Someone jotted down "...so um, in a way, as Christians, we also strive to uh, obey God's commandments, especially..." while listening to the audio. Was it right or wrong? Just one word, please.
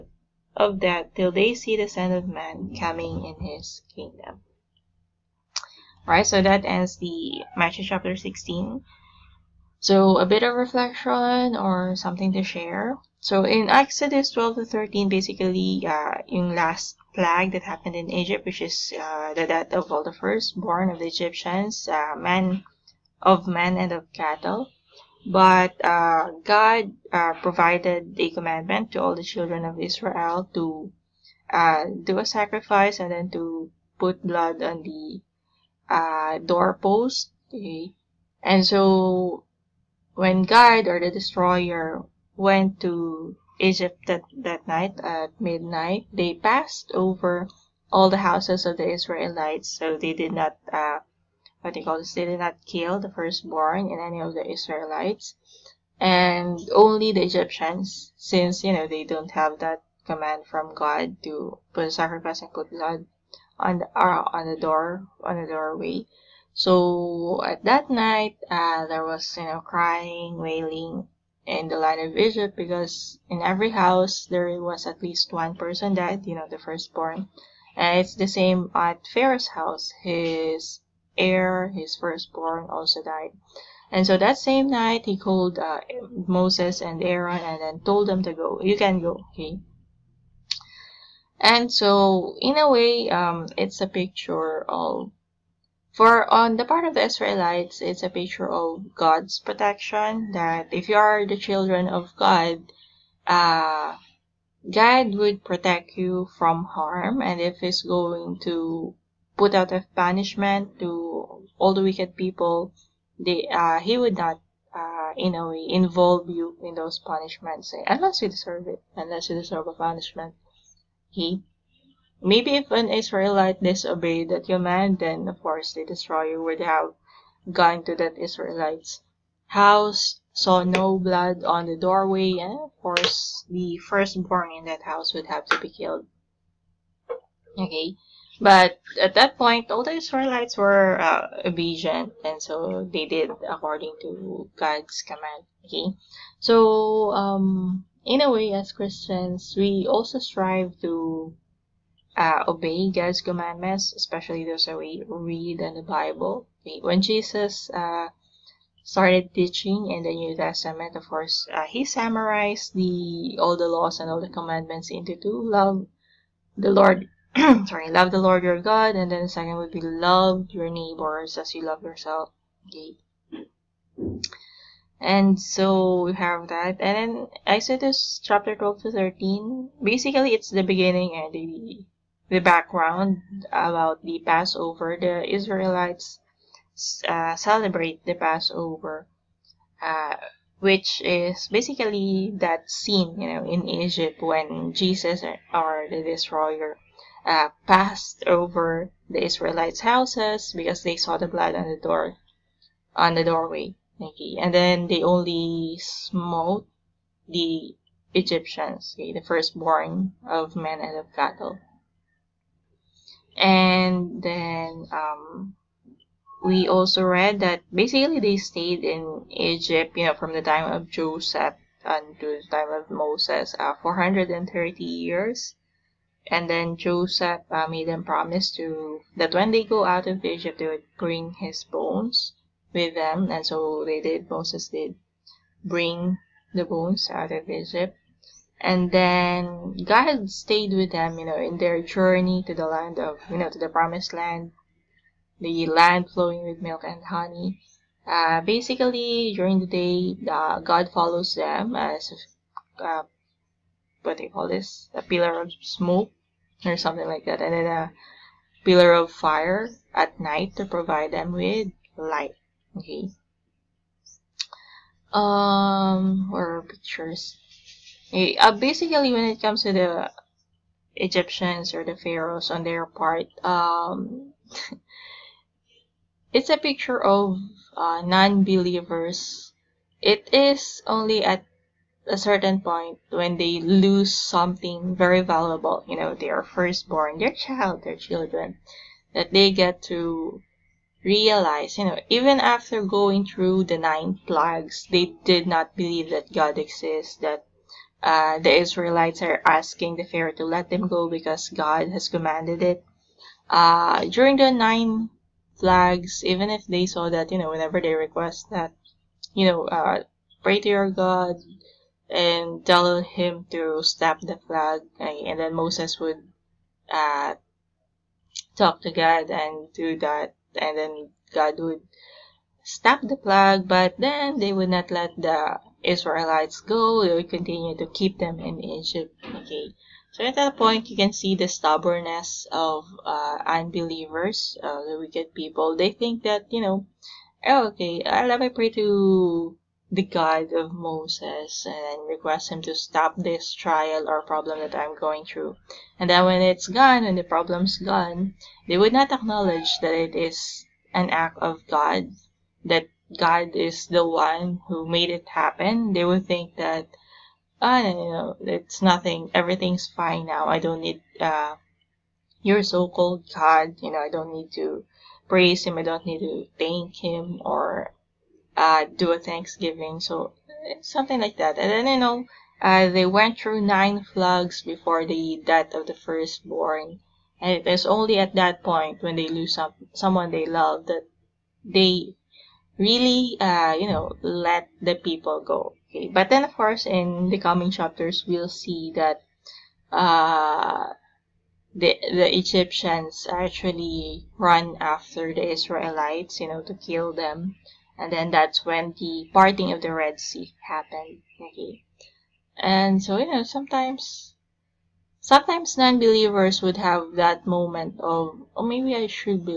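right.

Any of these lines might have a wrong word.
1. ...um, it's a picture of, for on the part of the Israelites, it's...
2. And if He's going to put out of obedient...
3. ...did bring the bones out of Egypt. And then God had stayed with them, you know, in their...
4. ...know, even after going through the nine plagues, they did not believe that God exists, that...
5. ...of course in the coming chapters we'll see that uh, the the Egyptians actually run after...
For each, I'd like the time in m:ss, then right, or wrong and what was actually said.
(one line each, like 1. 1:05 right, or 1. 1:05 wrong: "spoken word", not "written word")
1. 1:33 right
2. 1:47 wrong: "banishment", not "obedient"
3. 3:54 right
4. 4:51 right
5. 6:26 right.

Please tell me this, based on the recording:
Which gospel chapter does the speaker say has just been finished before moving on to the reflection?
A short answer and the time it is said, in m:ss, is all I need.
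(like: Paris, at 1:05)
Matthew 16, at 0:07.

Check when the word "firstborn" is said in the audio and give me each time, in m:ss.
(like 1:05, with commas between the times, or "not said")
0:20, 0:53, 1:16, 1:21, 2:13, 3:29, 4:46, 6:15.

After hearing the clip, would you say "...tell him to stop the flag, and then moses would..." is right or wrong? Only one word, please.
right.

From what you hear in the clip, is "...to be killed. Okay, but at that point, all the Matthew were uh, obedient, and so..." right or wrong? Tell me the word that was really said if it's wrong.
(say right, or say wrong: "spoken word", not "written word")
wrong: "Israelites", not "Matthew".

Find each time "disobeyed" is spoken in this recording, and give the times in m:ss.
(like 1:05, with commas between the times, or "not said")
2:03.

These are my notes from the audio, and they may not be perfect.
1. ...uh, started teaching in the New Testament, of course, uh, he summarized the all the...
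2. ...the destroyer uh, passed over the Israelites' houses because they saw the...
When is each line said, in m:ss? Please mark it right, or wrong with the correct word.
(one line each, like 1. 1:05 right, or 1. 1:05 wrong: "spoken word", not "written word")
1. 2:37 right
2. 3:15 right.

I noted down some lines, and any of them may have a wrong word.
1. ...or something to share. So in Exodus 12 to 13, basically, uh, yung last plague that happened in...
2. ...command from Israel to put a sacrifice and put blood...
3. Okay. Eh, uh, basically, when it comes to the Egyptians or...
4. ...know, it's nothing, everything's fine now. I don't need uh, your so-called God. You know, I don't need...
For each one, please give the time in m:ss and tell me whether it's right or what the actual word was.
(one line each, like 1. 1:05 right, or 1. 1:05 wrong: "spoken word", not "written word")
1. 0:11 right
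2. 1:00 wrong: "God", not "Israel"
3. 4:28 right
4. 5:58 right.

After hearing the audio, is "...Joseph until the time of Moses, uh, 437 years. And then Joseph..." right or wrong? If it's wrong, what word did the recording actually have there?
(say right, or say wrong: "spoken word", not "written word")
wrong: "430", not "437".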